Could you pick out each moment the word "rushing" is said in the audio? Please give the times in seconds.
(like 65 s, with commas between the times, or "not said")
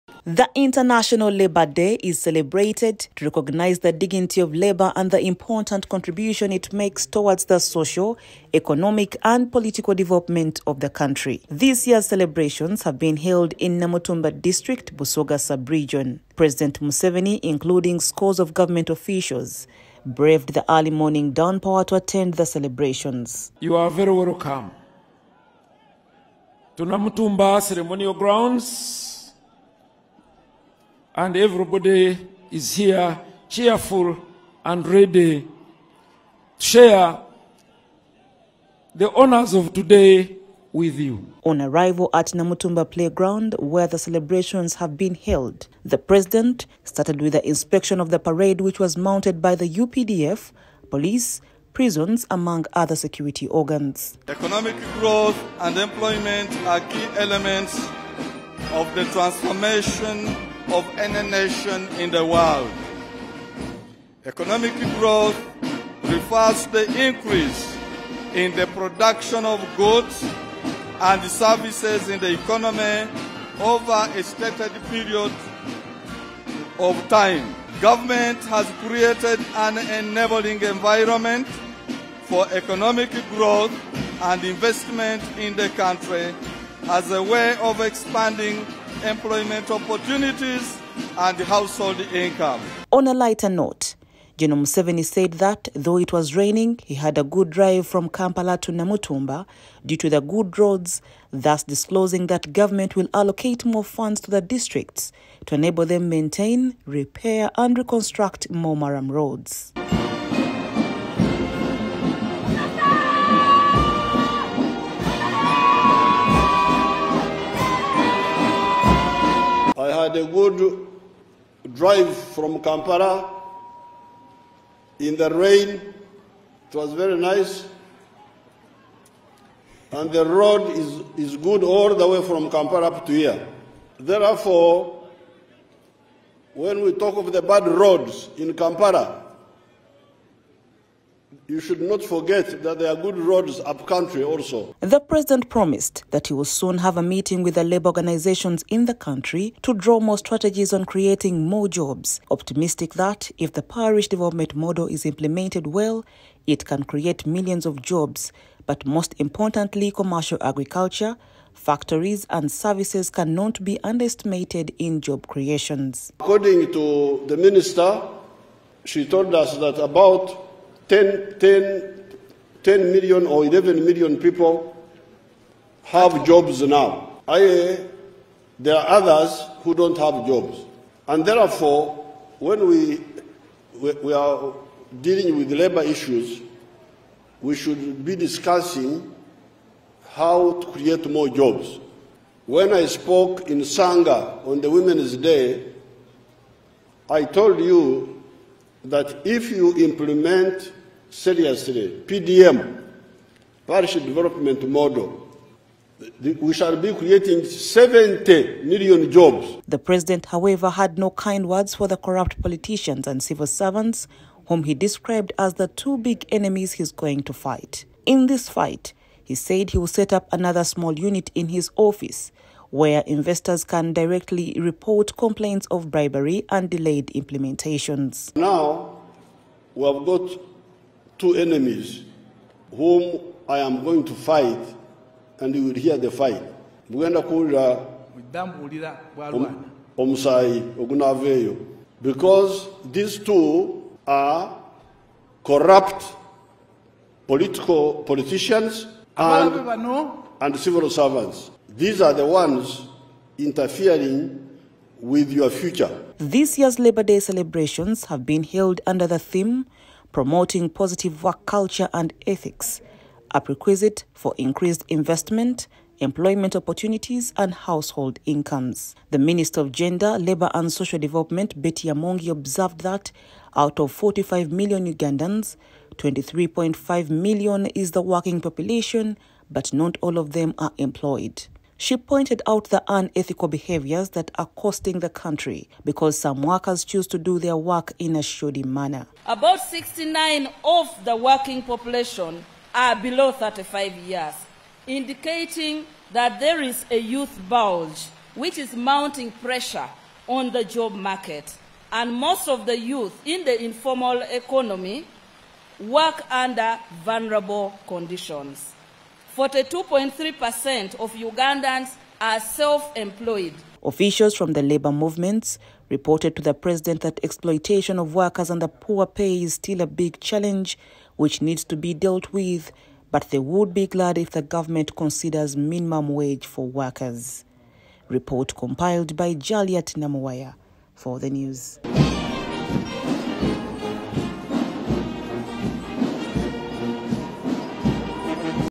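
not said.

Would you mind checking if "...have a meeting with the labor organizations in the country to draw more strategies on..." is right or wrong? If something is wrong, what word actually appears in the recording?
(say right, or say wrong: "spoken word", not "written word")
right.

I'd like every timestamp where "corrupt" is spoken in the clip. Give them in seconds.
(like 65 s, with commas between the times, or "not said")
211 s, 245 s.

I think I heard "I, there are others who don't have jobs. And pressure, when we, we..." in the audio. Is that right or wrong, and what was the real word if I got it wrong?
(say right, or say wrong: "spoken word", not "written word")
wrong: "therefore", not "pressure".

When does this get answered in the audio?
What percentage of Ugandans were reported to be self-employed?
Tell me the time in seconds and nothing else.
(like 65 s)
309 s.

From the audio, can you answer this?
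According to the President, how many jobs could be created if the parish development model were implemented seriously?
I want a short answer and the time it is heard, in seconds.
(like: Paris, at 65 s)
70 million, at 207 s.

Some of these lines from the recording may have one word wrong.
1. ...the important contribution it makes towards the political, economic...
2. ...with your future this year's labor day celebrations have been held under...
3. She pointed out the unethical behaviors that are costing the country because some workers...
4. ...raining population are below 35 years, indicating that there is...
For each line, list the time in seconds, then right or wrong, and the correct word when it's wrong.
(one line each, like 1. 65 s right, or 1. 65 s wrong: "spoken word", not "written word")
1. 5 s wrong: "social", not "political"
2. 254 s right
3. 281 s right
4. 291 s wrong: "working", not "raining".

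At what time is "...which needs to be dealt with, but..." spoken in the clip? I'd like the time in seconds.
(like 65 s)
321 s.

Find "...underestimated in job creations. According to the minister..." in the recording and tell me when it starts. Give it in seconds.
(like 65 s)
163 s.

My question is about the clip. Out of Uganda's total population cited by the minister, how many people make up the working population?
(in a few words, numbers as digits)
23.5 million.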